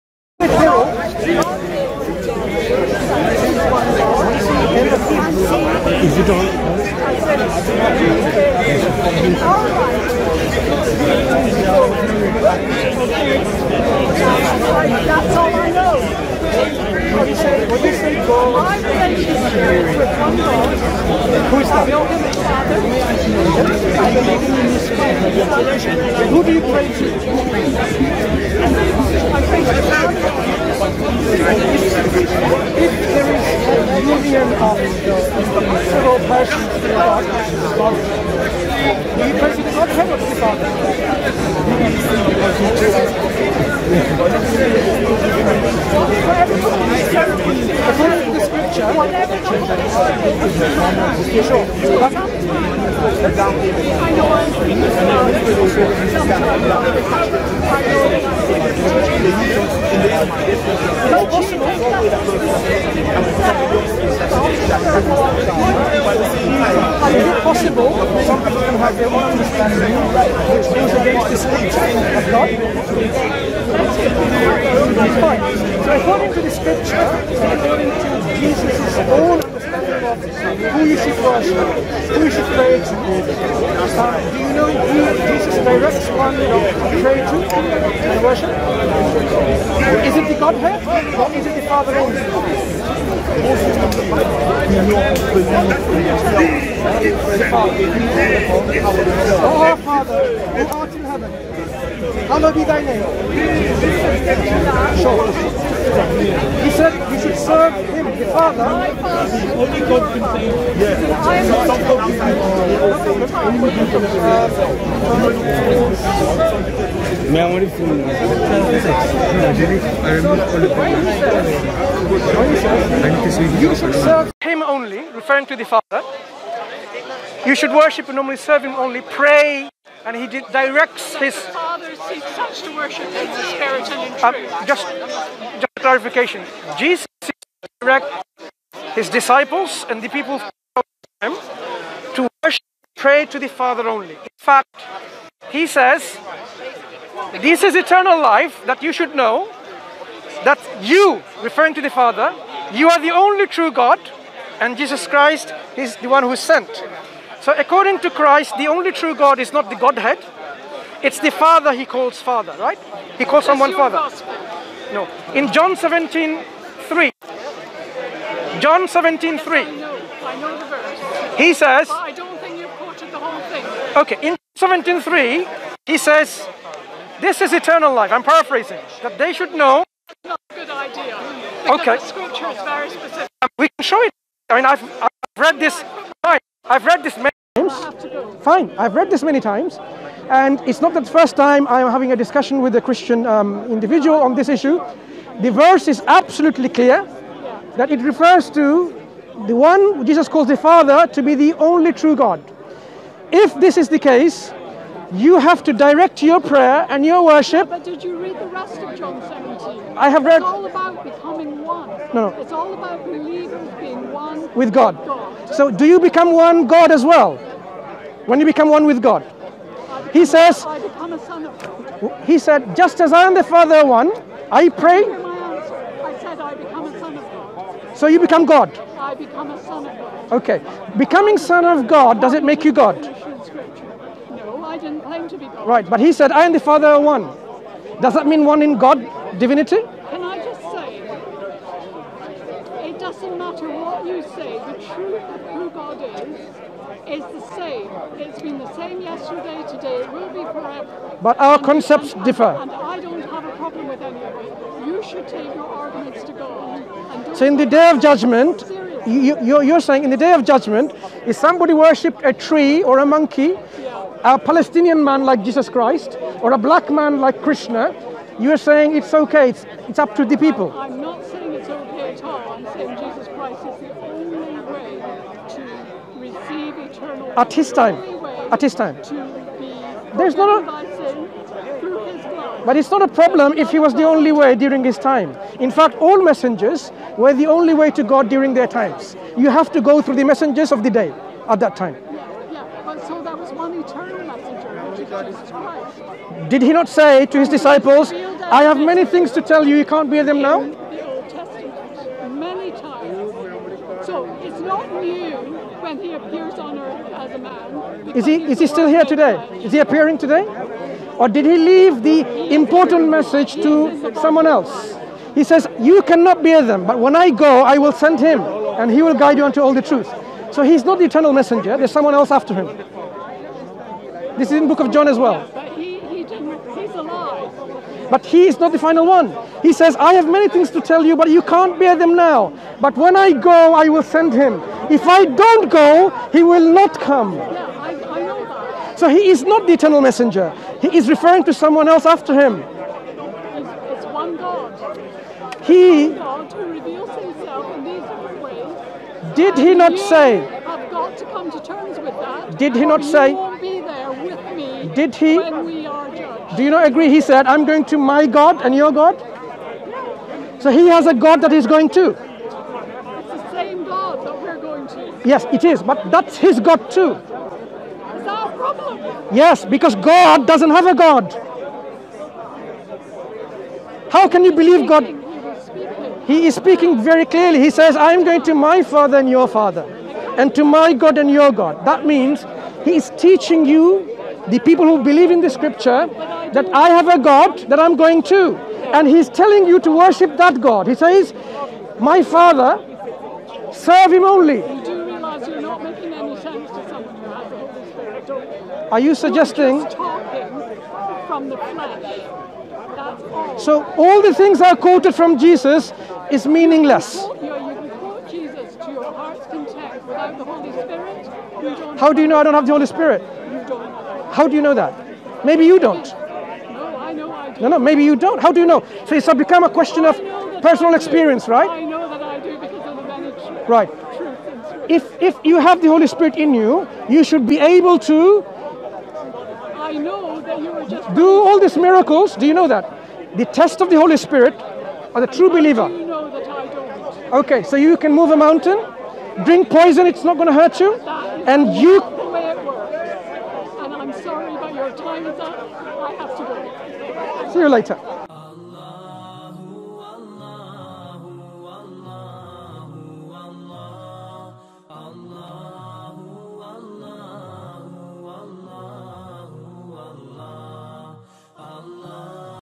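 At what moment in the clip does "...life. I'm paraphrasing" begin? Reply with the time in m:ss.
2:57.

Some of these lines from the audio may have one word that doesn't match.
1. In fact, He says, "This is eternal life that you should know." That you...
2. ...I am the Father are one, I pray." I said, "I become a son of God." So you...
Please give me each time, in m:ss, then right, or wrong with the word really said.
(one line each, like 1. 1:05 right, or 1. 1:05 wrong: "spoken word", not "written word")
1. 2:24 right
2. 3:43 right.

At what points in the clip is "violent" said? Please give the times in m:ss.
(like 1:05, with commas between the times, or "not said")
not said.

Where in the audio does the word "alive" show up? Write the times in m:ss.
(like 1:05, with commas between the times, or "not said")
5:26.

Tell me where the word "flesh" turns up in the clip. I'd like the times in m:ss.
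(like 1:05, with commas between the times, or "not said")
6:41.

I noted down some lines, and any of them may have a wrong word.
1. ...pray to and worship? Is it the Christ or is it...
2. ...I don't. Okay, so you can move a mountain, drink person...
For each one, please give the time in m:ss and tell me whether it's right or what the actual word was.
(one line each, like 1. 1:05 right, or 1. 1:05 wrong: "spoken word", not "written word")
1. 1:27 wrong: "Godhead", not "Christ"
2. 7:16 wrong: "poison", not "person".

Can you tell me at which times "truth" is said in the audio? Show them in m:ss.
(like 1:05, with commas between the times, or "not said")
2:14, 4:04, 5:19.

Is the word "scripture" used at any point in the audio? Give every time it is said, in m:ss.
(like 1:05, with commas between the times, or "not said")
0:48, 0:57, 1:16, 3:02, 6:25.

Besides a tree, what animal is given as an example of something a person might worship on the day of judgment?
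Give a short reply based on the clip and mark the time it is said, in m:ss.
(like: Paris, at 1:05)
a monkey, at 4:22.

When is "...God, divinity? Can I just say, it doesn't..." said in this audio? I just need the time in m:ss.
3:58.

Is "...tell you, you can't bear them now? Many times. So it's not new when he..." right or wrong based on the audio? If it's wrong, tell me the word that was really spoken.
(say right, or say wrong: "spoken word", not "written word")
right.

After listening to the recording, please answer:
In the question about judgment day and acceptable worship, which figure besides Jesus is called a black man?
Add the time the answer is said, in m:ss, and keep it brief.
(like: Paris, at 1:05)
Krishna, at 4:27.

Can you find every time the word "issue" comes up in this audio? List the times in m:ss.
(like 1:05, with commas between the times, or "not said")
3:14.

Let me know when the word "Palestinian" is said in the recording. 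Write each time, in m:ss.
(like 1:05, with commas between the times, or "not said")
4:24.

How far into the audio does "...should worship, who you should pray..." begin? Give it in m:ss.
1:20.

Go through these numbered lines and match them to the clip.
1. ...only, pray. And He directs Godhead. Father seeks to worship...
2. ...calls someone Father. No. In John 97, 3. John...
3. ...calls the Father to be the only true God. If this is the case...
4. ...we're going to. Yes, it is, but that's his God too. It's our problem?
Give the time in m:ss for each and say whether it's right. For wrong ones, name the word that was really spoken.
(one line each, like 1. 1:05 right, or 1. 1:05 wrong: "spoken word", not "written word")
1. 2:08 wrong: "His", not "Godhead"
2. 2:43 wrong: "17", not "97"
3. 3:20 right
4. 6:04 right.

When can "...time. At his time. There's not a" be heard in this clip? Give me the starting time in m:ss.
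4:37.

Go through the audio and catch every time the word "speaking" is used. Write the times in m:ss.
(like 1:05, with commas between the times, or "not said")
6:16.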